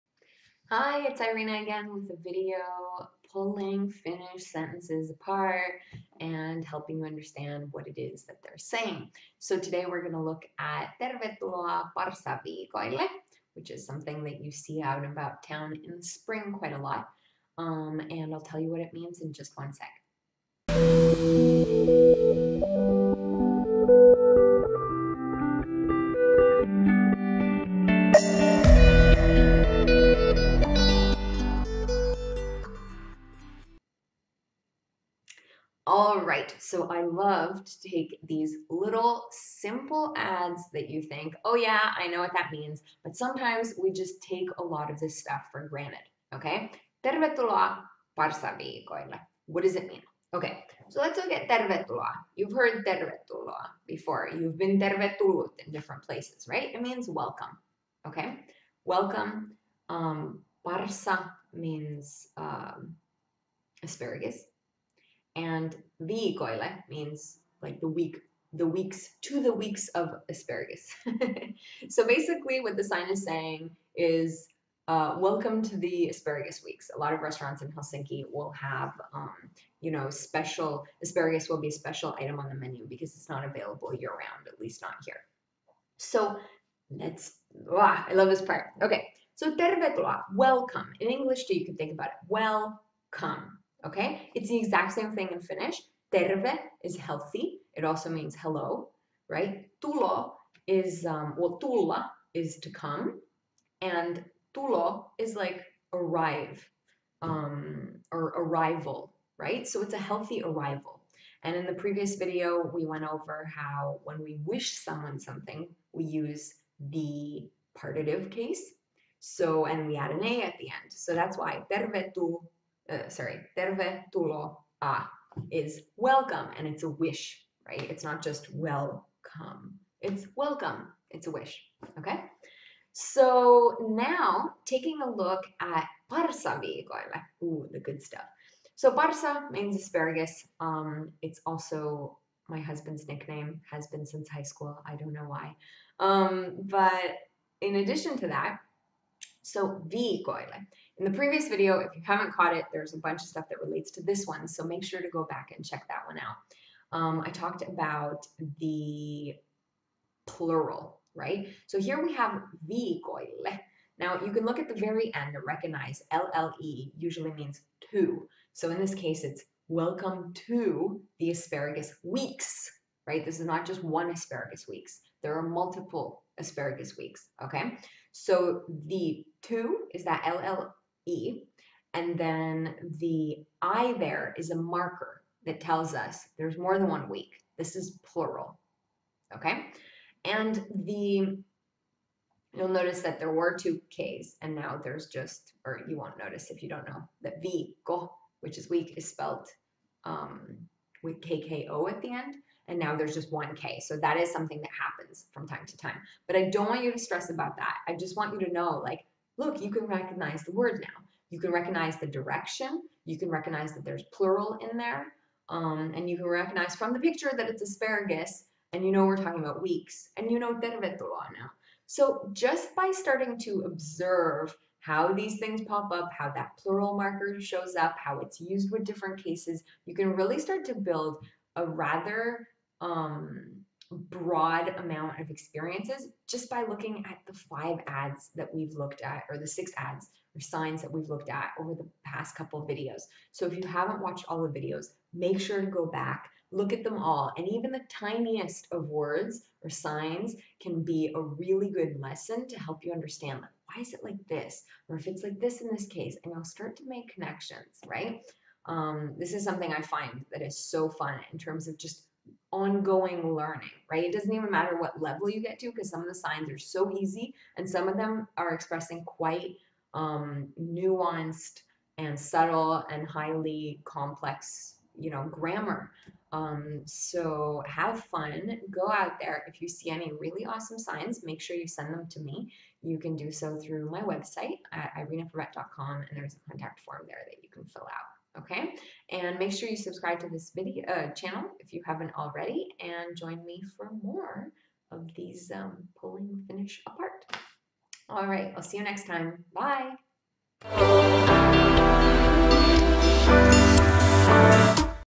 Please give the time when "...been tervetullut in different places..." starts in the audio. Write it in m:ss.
0:54.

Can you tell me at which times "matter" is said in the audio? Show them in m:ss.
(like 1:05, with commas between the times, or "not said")
4:24.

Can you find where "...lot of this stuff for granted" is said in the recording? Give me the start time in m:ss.
0:44.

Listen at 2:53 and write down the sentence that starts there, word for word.
This is not just one asparagus weeks.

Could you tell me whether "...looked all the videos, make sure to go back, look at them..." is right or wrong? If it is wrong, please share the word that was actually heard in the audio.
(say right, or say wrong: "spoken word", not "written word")
wrong: "watched", not "looked".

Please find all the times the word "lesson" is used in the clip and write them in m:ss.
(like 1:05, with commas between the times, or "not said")
4:11.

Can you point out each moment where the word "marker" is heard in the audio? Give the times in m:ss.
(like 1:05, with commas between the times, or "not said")
3:04, 3:46.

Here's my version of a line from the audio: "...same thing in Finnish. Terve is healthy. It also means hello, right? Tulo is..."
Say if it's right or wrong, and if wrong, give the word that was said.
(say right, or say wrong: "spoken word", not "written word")
right.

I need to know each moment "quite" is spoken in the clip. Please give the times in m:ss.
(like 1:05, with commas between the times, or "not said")
0:16, 4:29.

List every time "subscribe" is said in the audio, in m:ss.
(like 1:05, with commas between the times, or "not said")
4:49.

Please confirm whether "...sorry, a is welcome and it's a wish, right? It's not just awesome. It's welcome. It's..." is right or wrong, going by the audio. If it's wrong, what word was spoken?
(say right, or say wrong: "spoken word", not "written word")
wrong: "welcome", not "awesome".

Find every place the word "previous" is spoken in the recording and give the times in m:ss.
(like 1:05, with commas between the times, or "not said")
1:51, 2:31.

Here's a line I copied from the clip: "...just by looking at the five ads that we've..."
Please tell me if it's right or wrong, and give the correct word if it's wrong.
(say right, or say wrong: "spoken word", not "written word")
right.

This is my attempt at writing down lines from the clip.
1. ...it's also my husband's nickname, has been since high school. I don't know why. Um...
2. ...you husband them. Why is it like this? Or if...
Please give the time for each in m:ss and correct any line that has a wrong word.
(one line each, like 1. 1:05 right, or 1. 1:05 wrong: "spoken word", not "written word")
1. 2:21 right
2. 4:12 wrong: "understand", not "husband".